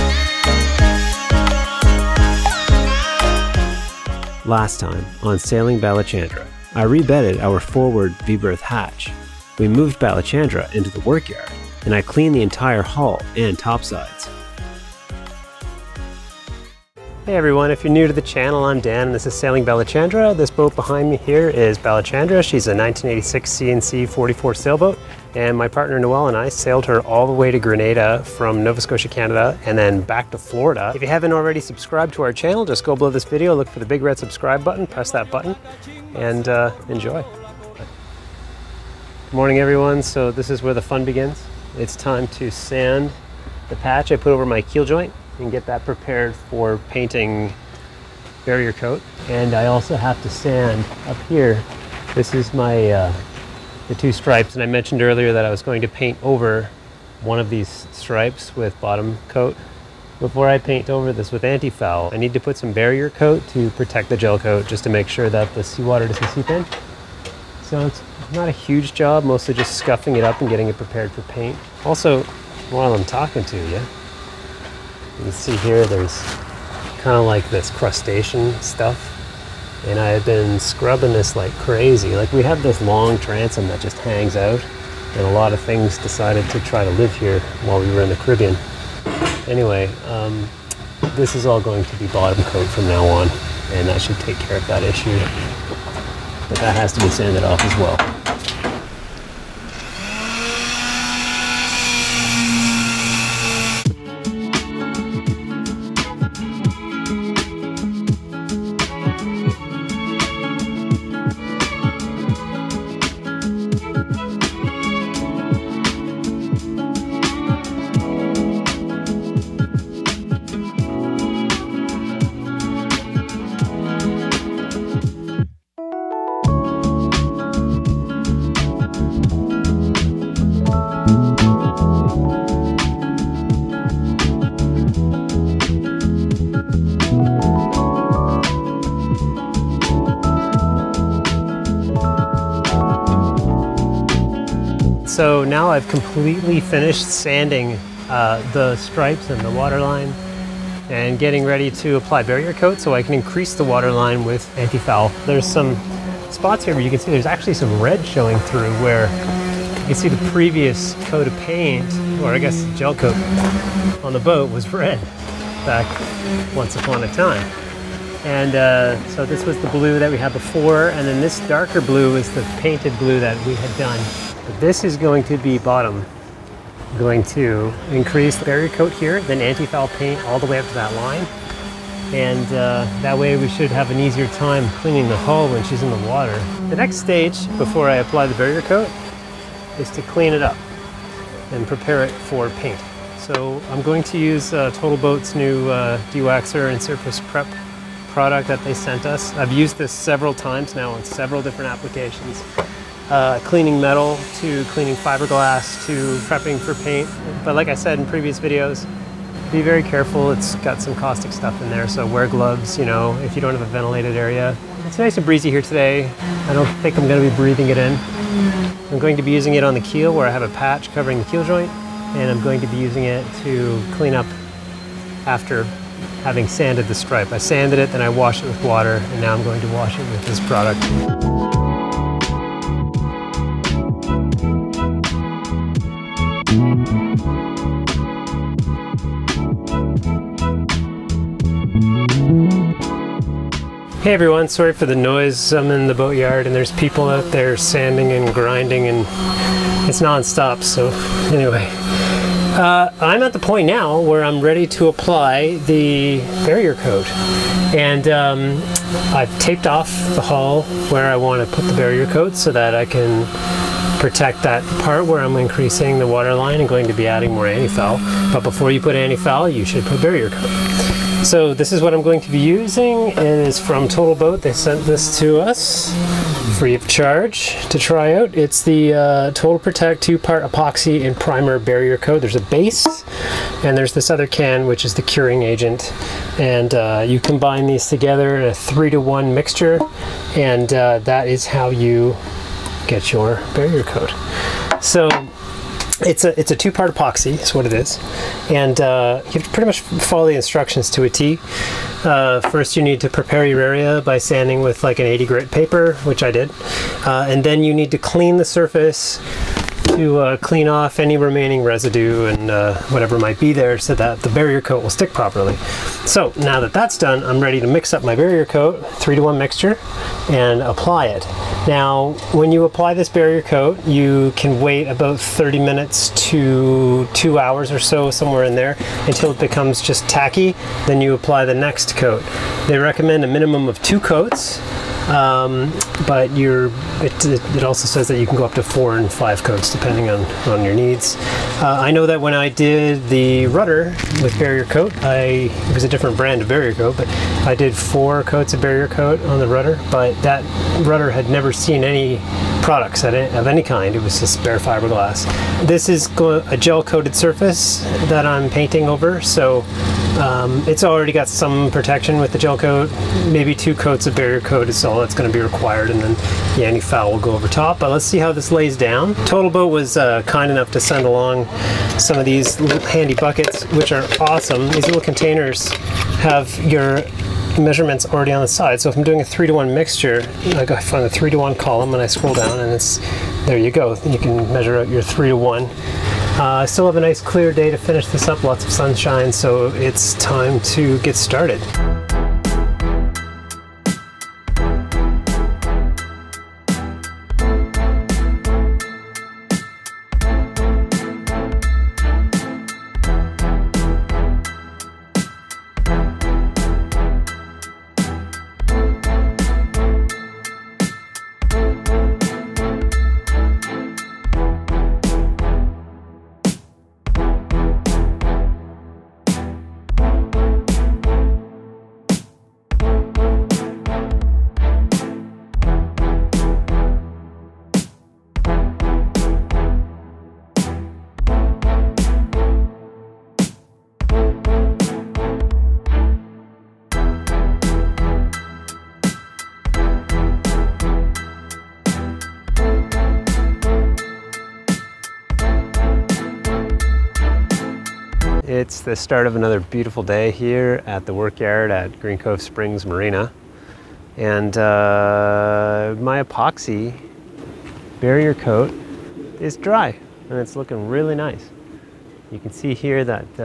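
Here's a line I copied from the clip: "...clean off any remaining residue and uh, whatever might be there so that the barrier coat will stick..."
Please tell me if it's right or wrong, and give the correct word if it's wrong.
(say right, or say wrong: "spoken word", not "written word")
right.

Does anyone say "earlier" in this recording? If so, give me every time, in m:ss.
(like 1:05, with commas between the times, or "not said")
0:55.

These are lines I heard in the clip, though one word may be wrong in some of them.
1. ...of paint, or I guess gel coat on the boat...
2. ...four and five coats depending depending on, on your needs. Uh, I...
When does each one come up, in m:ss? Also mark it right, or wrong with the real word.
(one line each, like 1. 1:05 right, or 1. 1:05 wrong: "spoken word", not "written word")
1. 2:41 right
2. 5:38 right.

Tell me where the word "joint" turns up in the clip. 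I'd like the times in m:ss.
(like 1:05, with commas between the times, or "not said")
0:44, 3:41.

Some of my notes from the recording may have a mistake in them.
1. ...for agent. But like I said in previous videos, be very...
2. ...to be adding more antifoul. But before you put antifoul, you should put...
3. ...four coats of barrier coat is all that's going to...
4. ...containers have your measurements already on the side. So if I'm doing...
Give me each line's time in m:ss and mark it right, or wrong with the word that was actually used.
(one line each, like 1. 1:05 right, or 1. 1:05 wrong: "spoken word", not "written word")
1. 3:26 wrong: "paint", not "agent"
2. 4:26 right
3. 6:03 wrong: "two", not "four"
4. 6:15 right.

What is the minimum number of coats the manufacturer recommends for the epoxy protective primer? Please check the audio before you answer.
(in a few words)
2.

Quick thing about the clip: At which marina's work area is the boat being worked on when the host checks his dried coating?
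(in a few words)
Green Cove Springs Marina.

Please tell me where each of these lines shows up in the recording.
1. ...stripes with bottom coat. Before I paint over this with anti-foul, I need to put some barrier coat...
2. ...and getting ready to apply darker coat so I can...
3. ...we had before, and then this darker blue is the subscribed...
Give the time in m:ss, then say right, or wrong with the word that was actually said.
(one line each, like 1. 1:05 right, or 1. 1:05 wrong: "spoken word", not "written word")
1. 0:57 right
2. 2:30 wrong: "barrier", not "darker"
3. 2:50 wrong: "painted", not "subscribed".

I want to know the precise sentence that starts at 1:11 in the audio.
Also, while I'm talking to you, you can see here there's kind of like this crustacean stuff.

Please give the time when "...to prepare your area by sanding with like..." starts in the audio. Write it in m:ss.
5:03.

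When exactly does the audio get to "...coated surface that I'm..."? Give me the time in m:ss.
5:56.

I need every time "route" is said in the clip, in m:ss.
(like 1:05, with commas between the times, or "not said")
not said.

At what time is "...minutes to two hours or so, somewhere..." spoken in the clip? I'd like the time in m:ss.
5:25.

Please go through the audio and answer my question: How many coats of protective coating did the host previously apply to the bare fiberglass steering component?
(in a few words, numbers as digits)
4.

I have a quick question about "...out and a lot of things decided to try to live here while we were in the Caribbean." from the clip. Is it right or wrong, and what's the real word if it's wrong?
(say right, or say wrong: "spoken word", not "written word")
right.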